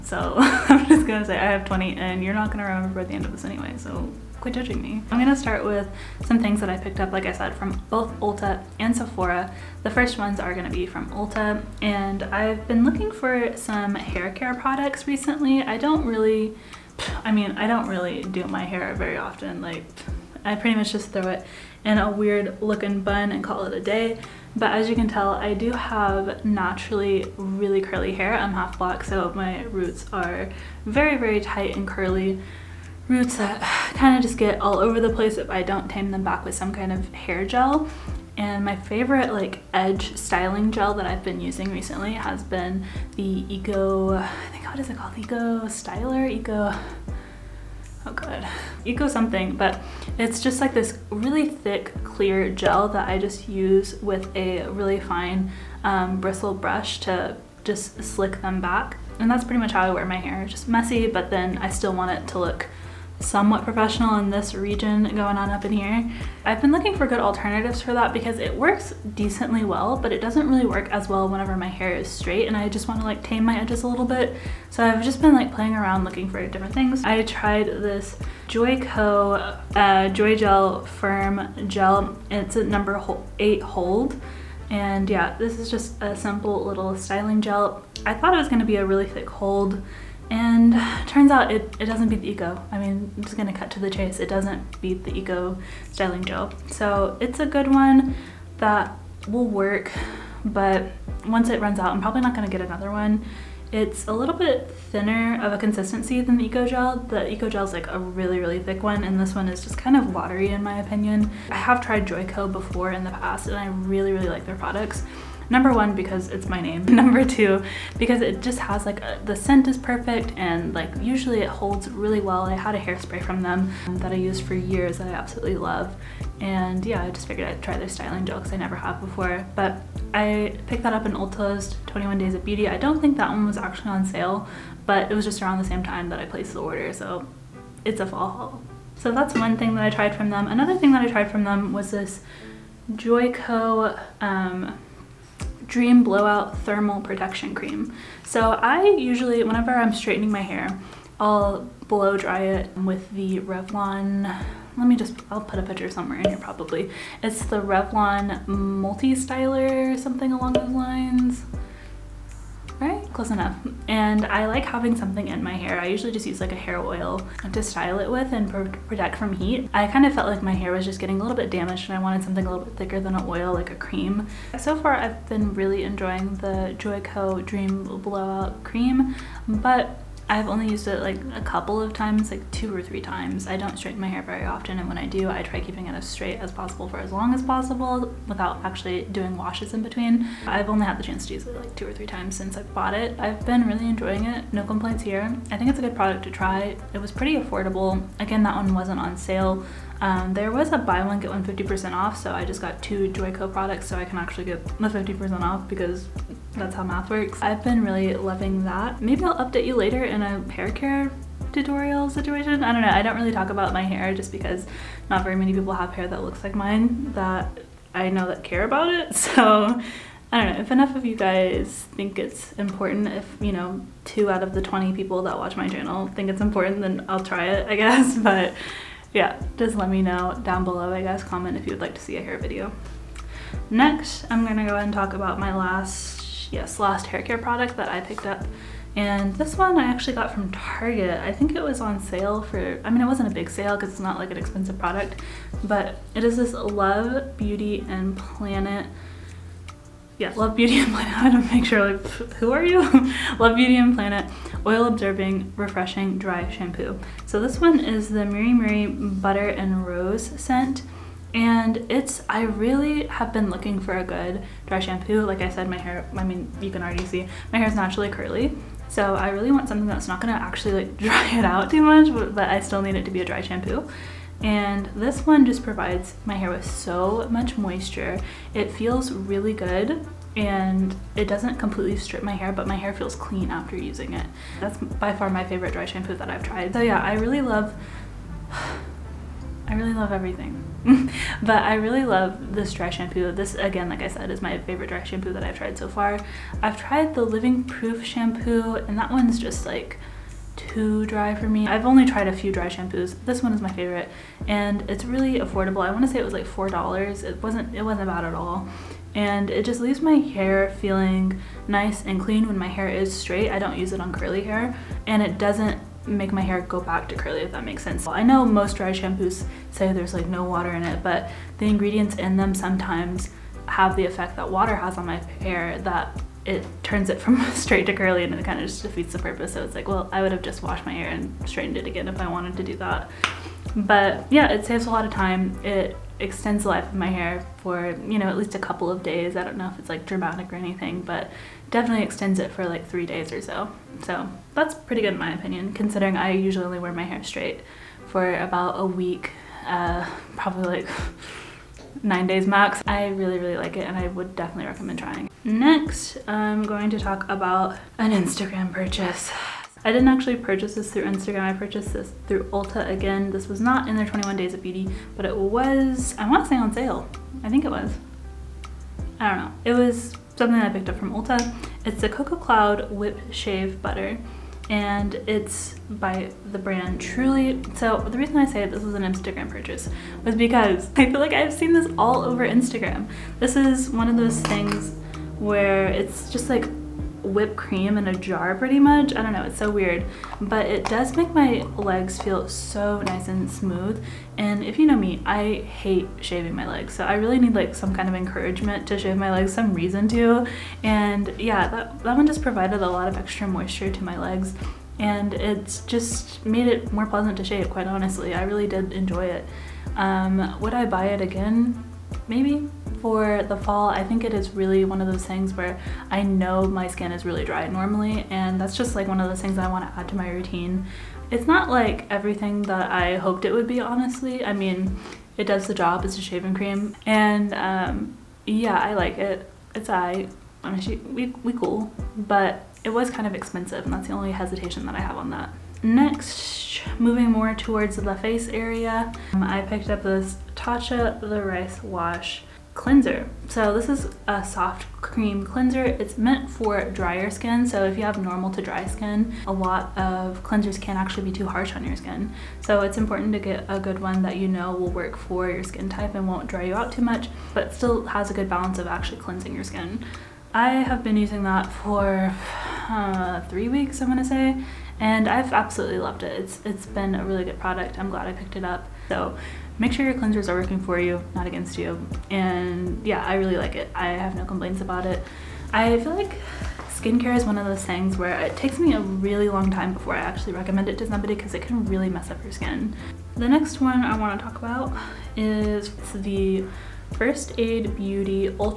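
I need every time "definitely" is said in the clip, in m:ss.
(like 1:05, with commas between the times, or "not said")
5:41, 5:54.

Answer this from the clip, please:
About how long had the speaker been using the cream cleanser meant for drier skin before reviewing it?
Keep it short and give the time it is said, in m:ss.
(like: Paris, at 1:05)
3 weeks, at 7:43.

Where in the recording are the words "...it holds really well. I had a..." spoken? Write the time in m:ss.
2:01.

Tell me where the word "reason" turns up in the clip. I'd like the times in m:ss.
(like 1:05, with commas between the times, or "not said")
6:18, 6:39.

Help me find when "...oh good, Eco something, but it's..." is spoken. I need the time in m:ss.
0:48.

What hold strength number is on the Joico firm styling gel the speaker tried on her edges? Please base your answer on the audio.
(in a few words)
8.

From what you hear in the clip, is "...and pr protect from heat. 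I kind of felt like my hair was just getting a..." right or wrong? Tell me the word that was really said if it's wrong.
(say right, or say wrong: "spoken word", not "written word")
right.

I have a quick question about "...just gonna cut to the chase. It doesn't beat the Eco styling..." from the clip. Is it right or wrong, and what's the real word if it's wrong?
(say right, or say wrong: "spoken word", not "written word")
right.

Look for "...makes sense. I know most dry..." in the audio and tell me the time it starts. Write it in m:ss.
5:17.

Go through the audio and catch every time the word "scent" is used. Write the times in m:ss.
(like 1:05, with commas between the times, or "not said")
1:59, 4:20.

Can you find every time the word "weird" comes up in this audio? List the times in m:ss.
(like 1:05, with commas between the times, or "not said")
0:22, 6:29.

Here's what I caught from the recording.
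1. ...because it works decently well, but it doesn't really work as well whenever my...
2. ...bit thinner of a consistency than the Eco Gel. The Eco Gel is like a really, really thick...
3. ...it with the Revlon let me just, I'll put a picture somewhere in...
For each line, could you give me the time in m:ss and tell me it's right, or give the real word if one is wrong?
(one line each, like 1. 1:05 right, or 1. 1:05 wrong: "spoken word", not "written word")
1. 1:08 right
2. 1:44 right
3. 2:32 right.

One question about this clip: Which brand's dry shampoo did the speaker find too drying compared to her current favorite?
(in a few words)
Living Proof.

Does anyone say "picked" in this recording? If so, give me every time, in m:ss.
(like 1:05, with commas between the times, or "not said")
0:06, 2:10, 3:57, 6:10, 7:19, 7:48.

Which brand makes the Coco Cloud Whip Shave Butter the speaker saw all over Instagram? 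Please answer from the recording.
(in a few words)
Truly.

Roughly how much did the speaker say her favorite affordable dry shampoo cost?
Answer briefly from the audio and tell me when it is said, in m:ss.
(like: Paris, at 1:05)
$4, at 5:06.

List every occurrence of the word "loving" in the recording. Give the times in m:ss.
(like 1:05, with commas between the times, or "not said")
3:28.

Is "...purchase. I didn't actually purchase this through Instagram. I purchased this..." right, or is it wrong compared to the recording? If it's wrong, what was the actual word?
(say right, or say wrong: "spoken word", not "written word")
right.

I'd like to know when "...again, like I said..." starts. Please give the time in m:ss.
4:53.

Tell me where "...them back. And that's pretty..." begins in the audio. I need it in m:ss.
0:58.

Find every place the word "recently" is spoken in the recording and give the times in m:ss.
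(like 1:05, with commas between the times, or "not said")
0:15, 0:41.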